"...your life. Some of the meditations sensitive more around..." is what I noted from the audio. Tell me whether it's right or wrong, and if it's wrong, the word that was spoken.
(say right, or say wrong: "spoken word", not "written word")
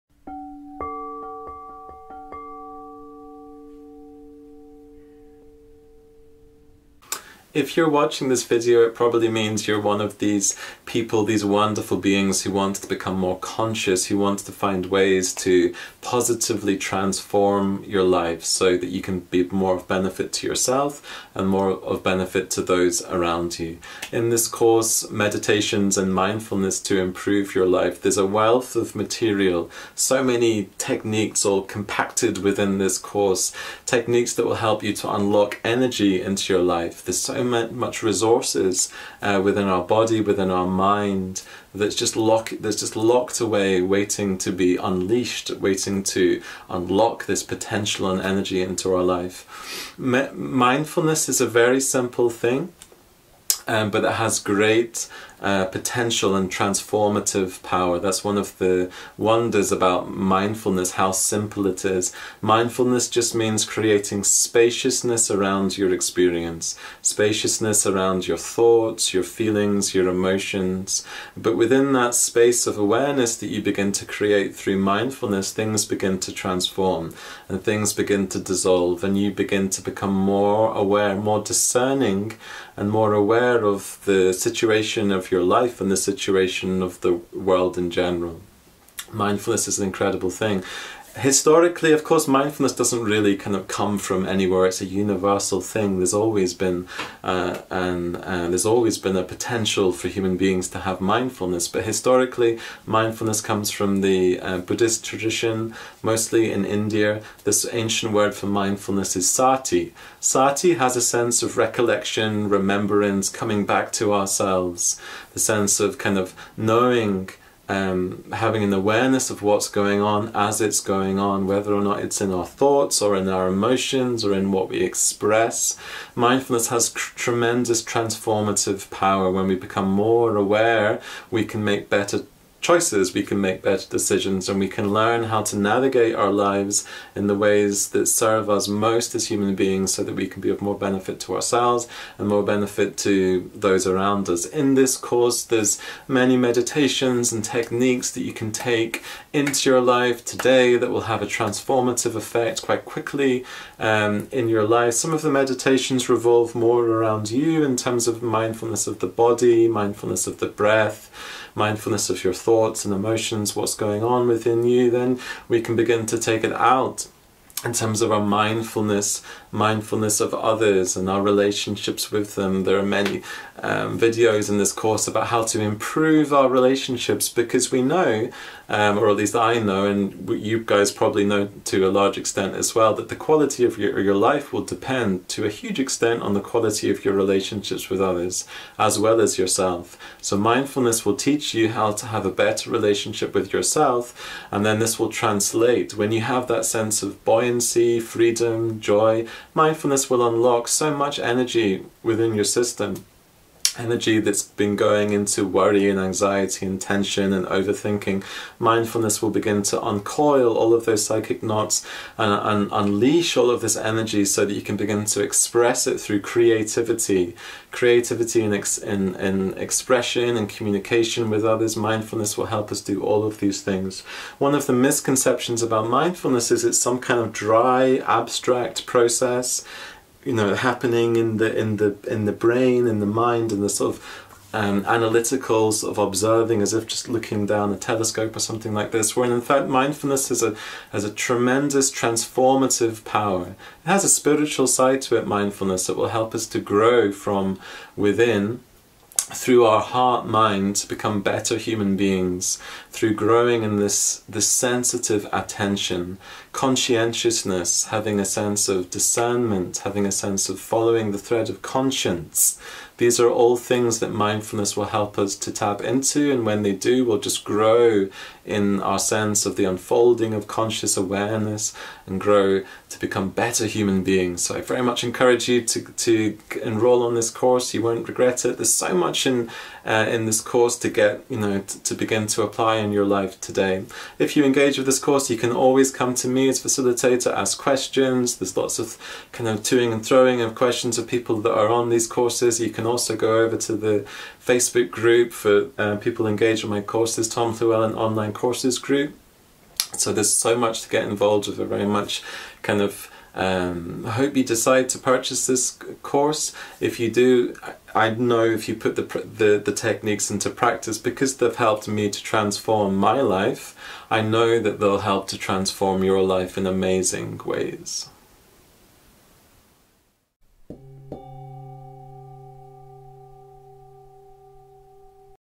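wrong: "revolve", not "sensitive".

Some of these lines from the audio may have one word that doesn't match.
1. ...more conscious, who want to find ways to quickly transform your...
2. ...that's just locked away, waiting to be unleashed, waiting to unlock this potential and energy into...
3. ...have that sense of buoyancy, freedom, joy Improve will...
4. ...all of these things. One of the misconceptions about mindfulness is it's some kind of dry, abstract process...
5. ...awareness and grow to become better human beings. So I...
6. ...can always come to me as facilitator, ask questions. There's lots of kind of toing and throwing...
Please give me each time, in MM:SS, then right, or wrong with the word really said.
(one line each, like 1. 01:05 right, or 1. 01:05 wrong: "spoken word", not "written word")
1. 00:13 wrong: "positively", not "quickly"
2. 00:42 right
3. 03:16 wrong: "Mindfulness", not "Improve"
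4. 03:43 right
5. 04:30 right
6. 04:45 right.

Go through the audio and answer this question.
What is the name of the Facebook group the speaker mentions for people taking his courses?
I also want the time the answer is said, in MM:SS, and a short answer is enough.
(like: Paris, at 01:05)
Tom Llewellyn Online Courses, at 04:57.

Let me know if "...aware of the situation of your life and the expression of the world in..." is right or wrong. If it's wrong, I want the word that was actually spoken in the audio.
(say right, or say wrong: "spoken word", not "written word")
wrong: "situation", not "expression".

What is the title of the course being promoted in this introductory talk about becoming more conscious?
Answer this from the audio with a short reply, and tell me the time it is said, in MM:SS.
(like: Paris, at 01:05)
Meditations and Mindfulness to Improve Your Life, at 00:25.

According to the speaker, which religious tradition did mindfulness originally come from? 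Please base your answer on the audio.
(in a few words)
Buddhist.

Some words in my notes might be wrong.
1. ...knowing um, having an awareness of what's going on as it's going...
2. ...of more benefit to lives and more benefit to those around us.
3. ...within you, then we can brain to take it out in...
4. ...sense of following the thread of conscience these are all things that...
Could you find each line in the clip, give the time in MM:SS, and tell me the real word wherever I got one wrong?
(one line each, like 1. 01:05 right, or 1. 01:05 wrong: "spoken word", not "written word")
1. 01:56 right
2. 02:20 wrong: "ourselves", not "lives"
3. 02:44 wrong: "begin", not "brain"
4. 04:20 right.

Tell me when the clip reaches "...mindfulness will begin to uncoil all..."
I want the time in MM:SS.
03:28.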